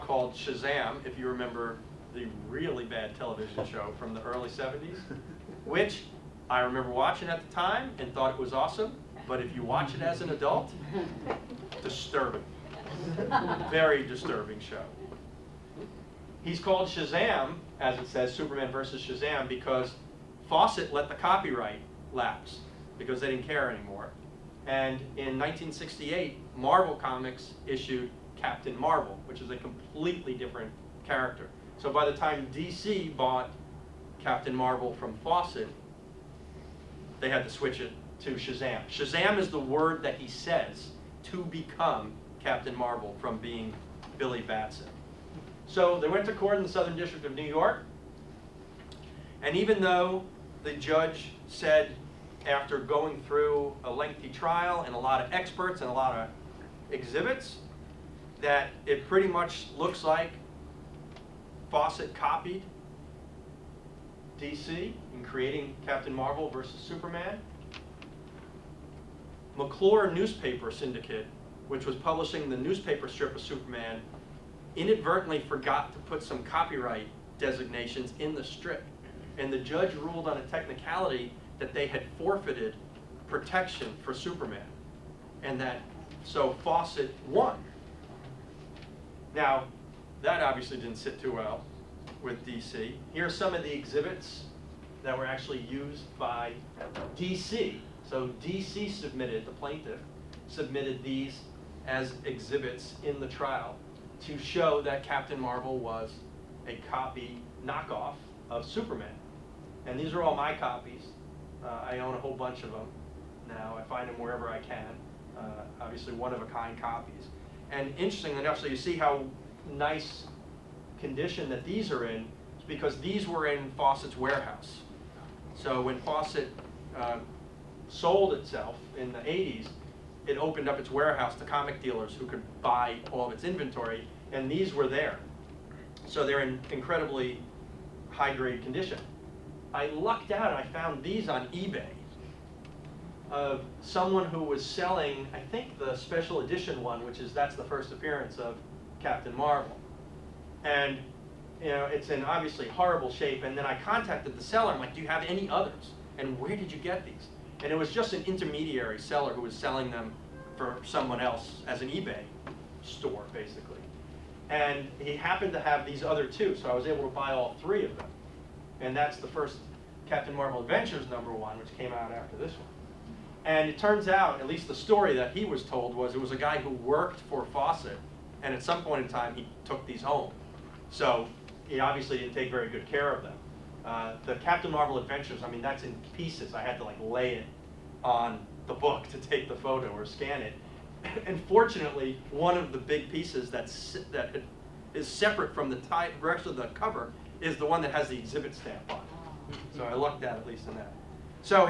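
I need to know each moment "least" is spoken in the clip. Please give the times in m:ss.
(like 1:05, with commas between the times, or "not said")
2:54, 3:20.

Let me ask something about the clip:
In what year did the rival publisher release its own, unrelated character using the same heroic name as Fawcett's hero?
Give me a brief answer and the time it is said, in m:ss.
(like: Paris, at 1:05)
1968, at 0:25.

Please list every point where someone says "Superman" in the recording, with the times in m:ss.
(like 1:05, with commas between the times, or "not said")
0:18, 1:06, 1:13, 1:24, 1:48.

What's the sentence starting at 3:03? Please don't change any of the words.
Uh, the Captain Marvel Adventures, I mean, that's in pieces.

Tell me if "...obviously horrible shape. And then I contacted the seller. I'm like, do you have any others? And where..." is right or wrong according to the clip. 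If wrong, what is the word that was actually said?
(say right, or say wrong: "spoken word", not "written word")
right.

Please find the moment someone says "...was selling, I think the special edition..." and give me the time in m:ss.
2:24.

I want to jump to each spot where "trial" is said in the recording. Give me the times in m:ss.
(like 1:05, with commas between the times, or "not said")
0:54, 1:43.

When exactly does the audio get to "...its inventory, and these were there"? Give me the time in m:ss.
2:13.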